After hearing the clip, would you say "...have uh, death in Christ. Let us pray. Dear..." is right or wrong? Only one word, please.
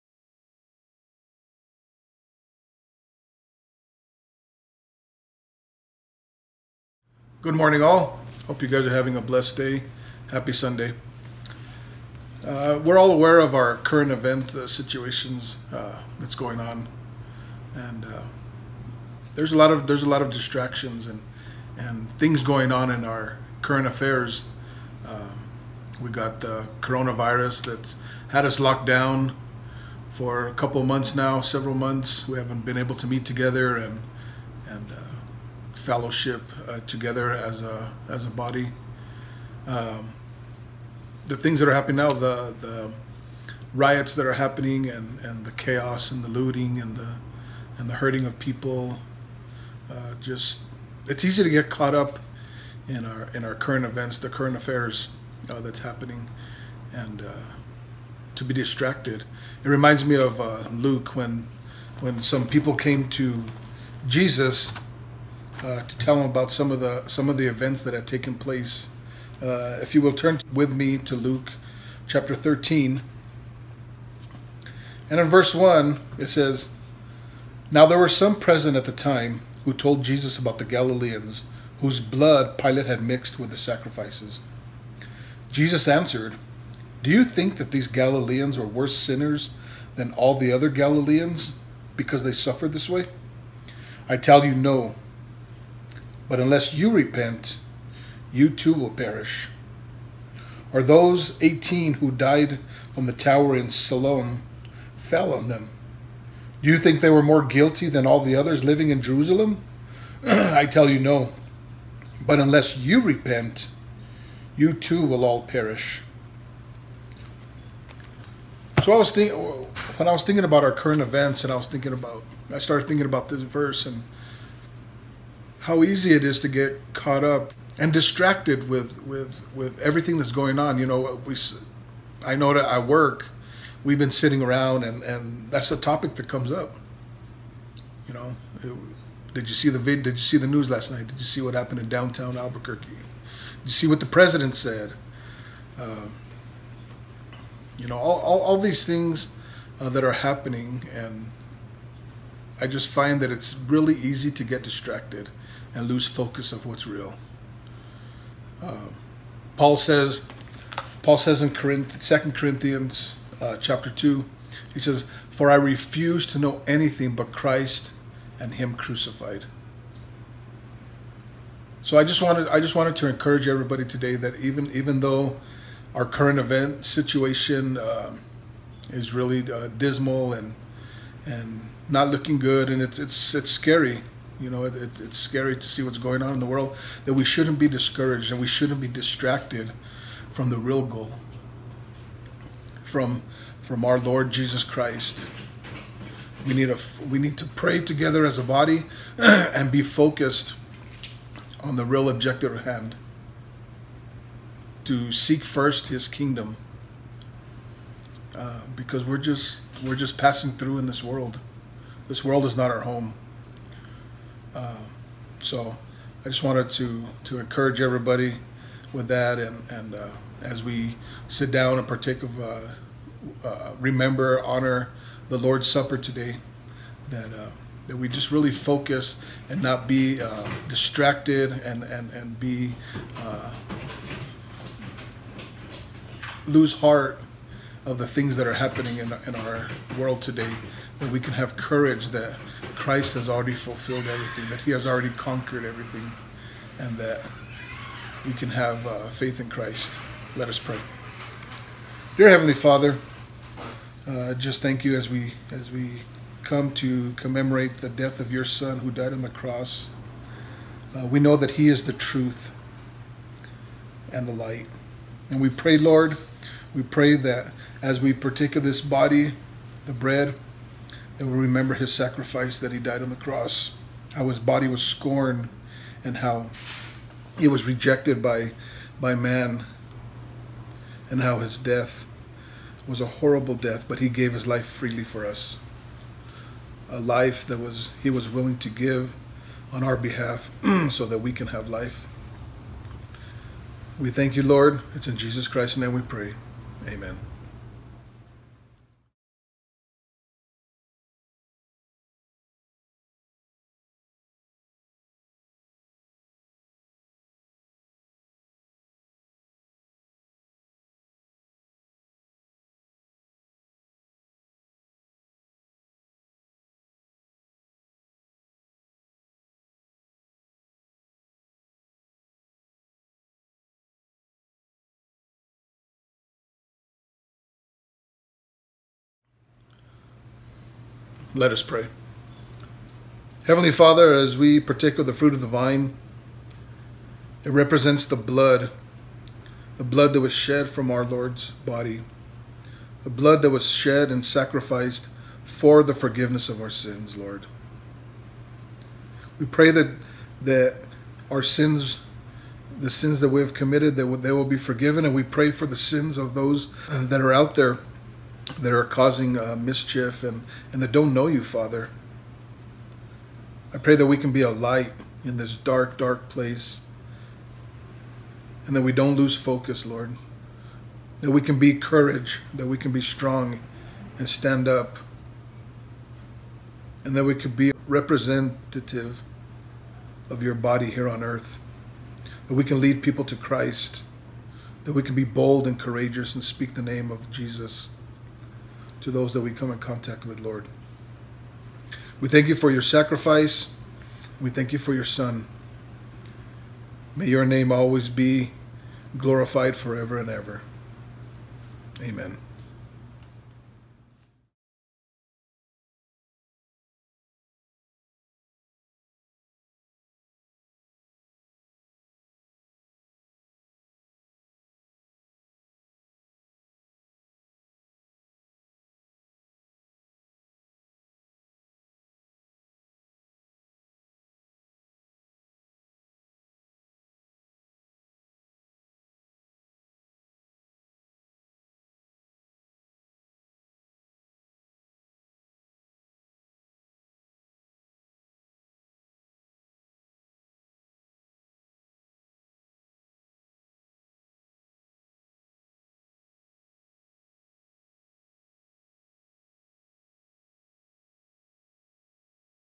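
wrong.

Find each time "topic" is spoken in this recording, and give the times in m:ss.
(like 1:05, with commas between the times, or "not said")
2:15.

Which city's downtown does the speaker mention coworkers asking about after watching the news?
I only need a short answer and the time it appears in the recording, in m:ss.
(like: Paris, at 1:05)
Albuquerque, at 2:22.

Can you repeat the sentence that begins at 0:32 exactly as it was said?
We haven't been able to meet together, and and uh, fellowship uh, together as a as a body.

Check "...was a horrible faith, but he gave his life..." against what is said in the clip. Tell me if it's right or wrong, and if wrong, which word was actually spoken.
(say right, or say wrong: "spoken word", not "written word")
wrong: "death", not "faith".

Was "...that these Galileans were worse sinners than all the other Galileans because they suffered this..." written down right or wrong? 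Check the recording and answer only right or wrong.
right.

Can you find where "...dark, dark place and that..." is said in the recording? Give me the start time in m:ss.
6:05.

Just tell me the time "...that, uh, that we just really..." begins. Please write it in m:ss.
3:47.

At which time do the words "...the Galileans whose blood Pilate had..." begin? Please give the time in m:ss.
1:20.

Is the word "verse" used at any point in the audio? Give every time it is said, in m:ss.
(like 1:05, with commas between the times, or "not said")
1:15, 2:03.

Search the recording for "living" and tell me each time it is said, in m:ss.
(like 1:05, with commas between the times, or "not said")
1:48.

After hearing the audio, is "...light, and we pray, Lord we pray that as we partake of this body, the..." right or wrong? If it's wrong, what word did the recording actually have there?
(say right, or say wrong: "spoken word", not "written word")
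right.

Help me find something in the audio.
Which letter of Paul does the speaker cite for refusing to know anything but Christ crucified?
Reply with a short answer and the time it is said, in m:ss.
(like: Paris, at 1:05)
2 Corinthians, at 2:42.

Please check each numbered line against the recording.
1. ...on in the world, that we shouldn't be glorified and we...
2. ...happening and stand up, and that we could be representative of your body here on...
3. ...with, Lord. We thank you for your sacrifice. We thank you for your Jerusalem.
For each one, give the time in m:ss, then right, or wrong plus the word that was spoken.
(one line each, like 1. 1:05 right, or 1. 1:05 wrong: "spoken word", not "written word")
1. 3:06 wrong: "discouraged", not "glorified"
2. 6:13 wrong: "strong", not "happening"
3. 6:30 wrong: "Son", not "Jerusalem".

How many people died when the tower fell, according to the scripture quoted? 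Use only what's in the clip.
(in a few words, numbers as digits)
18.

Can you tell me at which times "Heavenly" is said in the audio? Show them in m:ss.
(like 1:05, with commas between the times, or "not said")
4:12, 5:33.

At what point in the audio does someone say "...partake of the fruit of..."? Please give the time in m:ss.
5:34.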